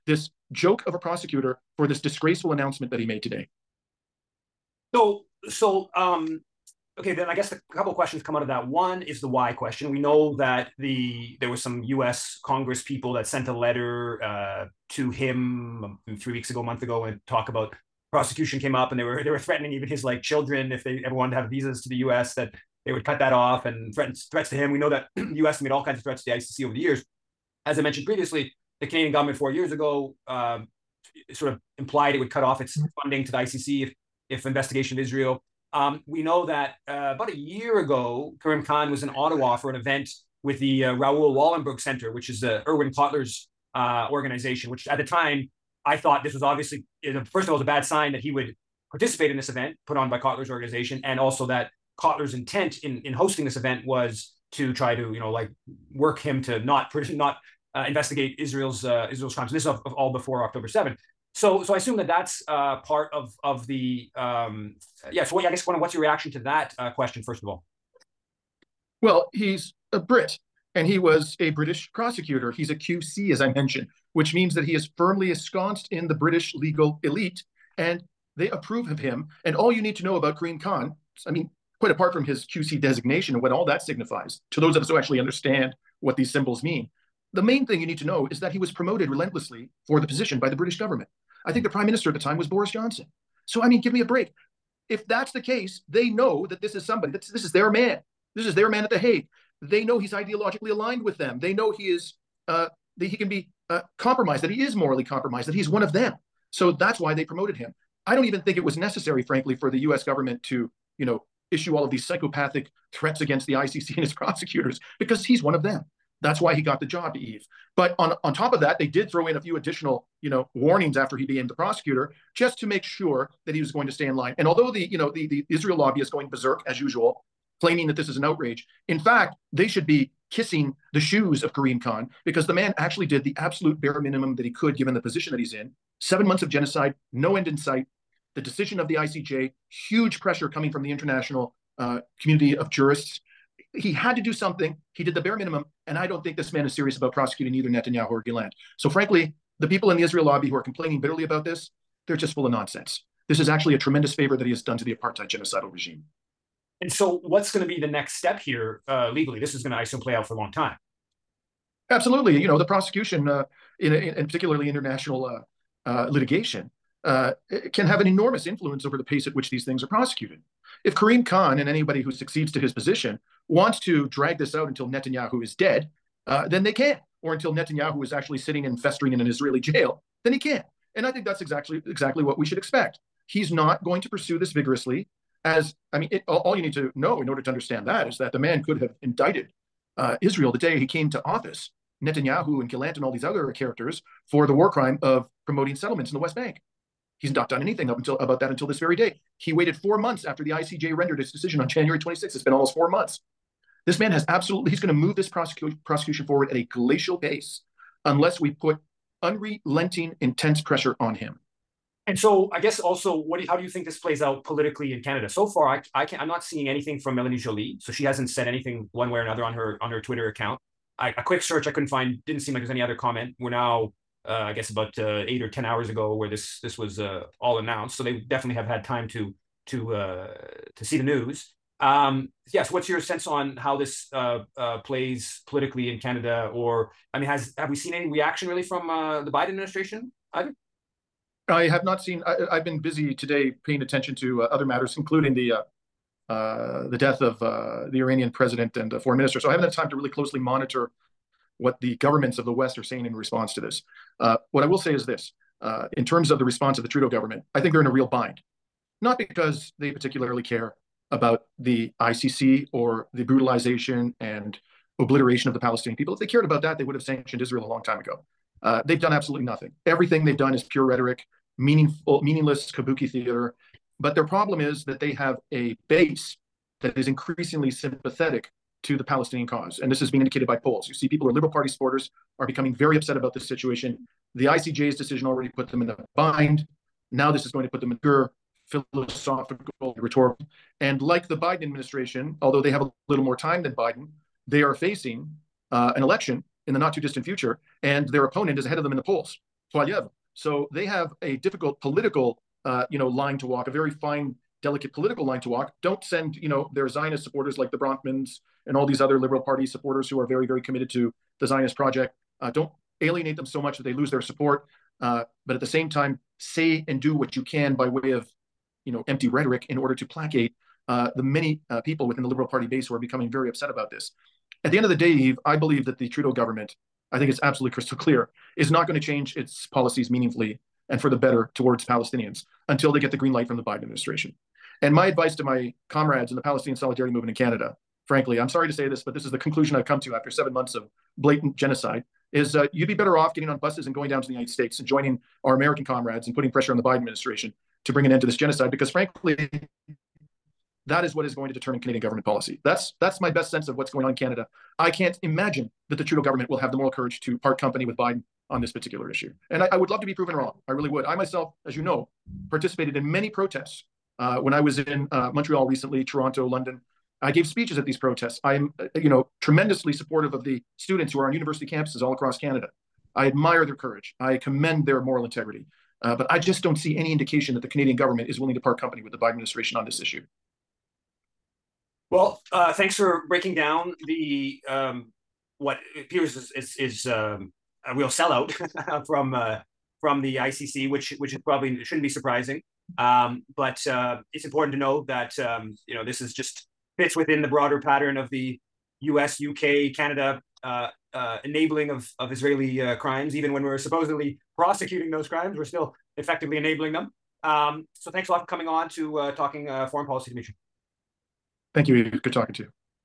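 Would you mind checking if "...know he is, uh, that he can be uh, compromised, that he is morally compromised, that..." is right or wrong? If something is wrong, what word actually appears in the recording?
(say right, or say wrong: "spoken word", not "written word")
right.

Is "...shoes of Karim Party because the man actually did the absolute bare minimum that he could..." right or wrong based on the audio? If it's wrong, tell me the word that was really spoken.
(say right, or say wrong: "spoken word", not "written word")
wrong: "Khan", not "Party".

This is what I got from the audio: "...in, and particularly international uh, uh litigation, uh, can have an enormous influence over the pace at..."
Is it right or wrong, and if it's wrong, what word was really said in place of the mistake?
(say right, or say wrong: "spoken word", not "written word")
right.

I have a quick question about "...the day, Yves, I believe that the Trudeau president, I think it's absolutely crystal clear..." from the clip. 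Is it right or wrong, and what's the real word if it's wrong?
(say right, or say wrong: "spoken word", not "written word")
wrong: "government", not "president".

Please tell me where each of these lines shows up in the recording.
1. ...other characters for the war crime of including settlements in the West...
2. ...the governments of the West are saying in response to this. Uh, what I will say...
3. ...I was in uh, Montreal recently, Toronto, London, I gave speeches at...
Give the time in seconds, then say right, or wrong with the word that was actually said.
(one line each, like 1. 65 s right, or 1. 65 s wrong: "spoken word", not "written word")
1. 193 s wrong: "promoting", not "including"
2. 251 s right
3. 364 s right.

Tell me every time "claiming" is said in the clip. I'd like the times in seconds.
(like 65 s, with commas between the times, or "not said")
127 s.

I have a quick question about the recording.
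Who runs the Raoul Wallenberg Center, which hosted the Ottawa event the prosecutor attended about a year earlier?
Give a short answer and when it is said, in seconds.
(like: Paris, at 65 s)
Erwin Kotler, at 42 s.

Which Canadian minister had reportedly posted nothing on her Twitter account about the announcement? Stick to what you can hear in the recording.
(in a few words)
Melanie Joly.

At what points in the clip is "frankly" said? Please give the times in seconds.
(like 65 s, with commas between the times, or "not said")
109 s, 148 s, 338 s, 348 s.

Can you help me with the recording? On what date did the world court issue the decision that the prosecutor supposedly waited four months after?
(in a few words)
January 26th.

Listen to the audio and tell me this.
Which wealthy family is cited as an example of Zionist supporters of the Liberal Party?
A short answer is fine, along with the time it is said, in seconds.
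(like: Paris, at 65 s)
Bronfmans, at 307 s.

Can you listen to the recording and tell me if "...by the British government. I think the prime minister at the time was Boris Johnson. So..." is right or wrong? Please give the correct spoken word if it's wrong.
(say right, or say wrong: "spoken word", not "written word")
right.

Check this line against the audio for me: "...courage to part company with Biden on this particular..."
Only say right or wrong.
right.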